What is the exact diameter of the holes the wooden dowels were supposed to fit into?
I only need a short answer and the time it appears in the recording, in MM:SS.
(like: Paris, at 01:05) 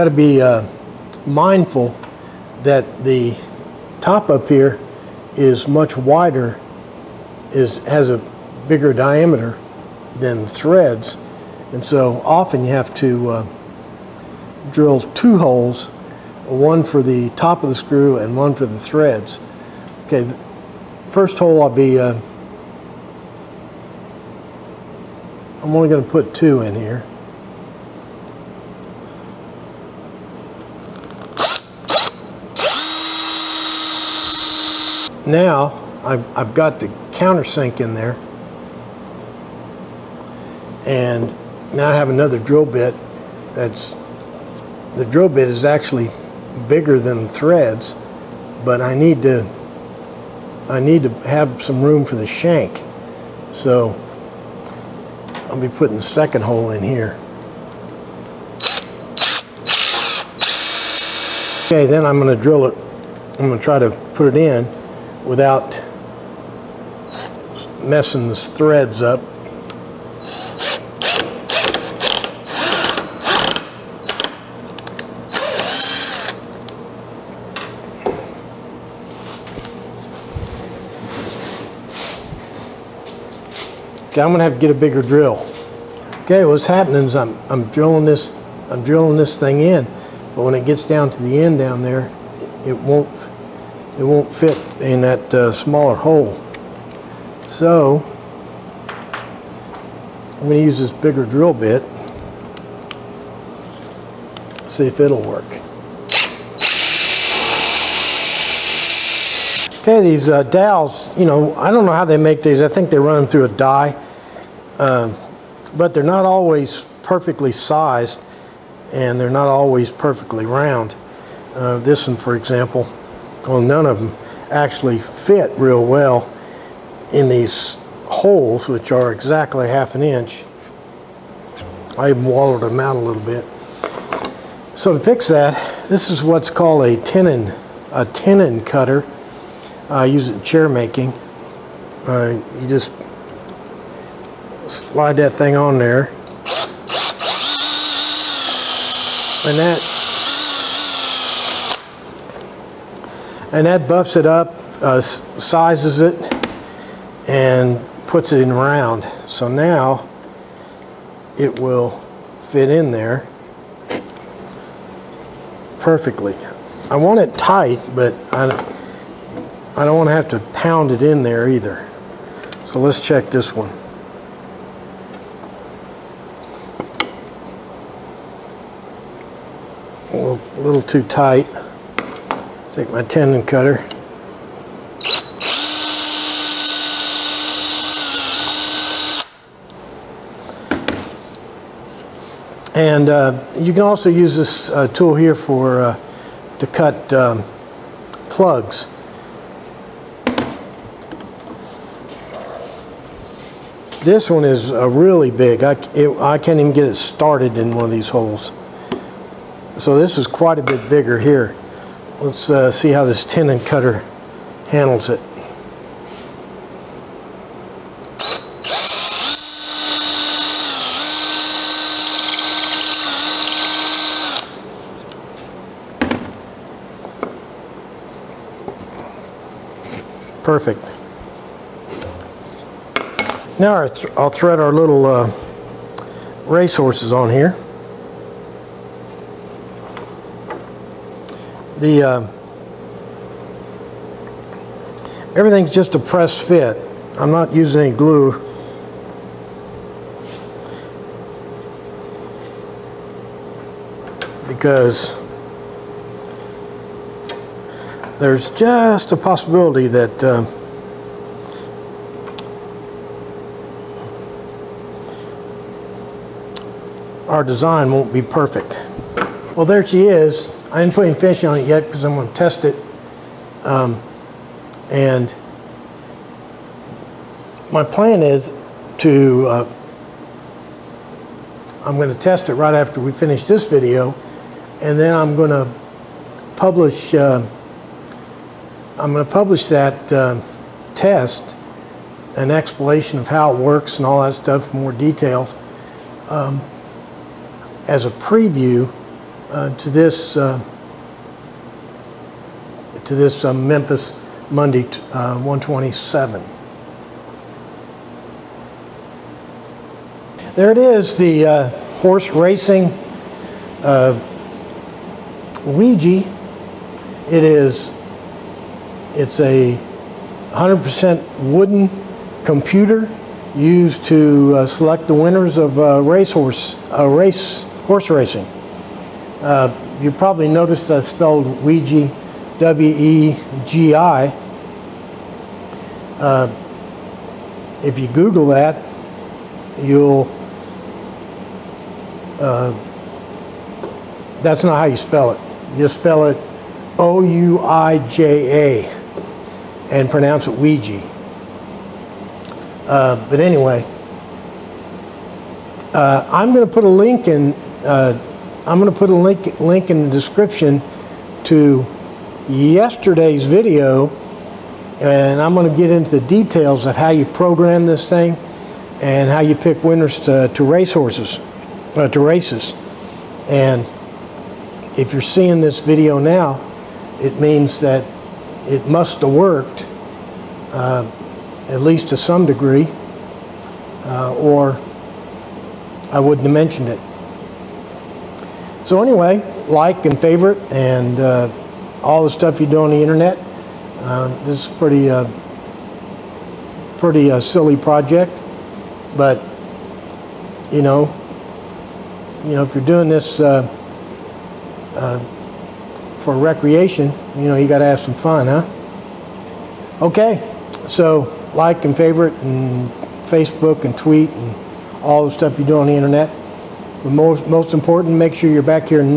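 half an inch, at 02:09.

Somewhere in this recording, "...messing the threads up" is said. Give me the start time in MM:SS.
01:07.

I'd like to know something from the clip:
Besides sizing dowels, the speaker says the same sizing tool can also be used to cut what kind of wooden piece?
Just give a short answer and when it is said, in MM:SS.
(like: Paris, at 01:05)
plugs, at 03:18.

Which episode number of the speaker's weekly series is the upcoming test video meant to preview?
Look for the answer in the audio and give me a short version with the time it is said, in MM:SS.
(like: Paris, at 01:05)
127, at 05:05.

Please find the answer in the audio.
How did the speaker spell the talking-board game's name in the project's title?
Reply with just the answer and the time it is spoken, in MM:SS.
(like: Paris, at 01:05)
WEGI, at 05:32.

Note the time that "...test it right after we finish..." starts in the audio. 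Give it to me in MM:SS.
04:42.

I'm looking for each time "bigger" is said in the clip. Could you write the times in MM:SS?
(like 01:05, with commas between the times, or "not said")
00:08, 00:46, 01:24, 01:40, 03:30.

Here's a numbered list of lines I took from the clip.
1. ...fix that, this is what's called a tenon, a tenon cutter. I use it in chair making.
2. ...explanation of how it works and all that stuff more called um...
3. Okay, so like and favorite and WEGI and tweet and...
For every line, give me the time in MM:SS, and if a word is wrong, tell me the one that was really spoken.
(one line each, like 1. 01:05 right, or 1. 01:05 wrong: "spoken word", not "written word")
1. 02:14 right
2. 04:52 wrong: "detailed", not "called"
3. 06:50 wrong: "Facebook", not "WEGI".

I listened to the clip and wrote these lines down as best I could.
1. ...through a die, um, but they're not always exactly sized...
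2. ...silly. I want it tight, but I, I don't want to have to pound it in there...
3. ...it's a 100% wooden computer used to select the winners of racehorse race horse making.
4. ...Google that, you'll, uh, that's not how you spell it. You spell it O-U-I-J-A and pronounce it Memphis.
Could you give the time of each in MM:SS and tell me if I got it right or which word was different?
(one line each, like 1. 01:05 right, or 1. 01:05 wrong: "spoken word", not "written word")
1. 01:53 wrong: "perfectly", not "exactly"
2. 02:45 wrong: "perfectly", not "silly"
3. 05:19 wrong: "racing", not "making"
4. 05:38 wrong: "Ouija", not "Memphis".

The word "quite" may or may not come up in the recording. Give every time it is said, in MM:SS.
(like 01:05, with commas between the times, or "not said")
03:30.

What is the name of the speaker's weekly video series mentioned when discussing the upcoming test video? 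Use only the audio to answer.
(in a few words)
Memphis Monday.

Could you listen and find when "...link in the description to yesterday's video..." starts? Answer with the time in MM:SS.
05:59.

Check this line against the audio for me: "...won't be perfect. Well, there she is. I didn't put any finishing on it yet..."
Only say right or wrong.
right.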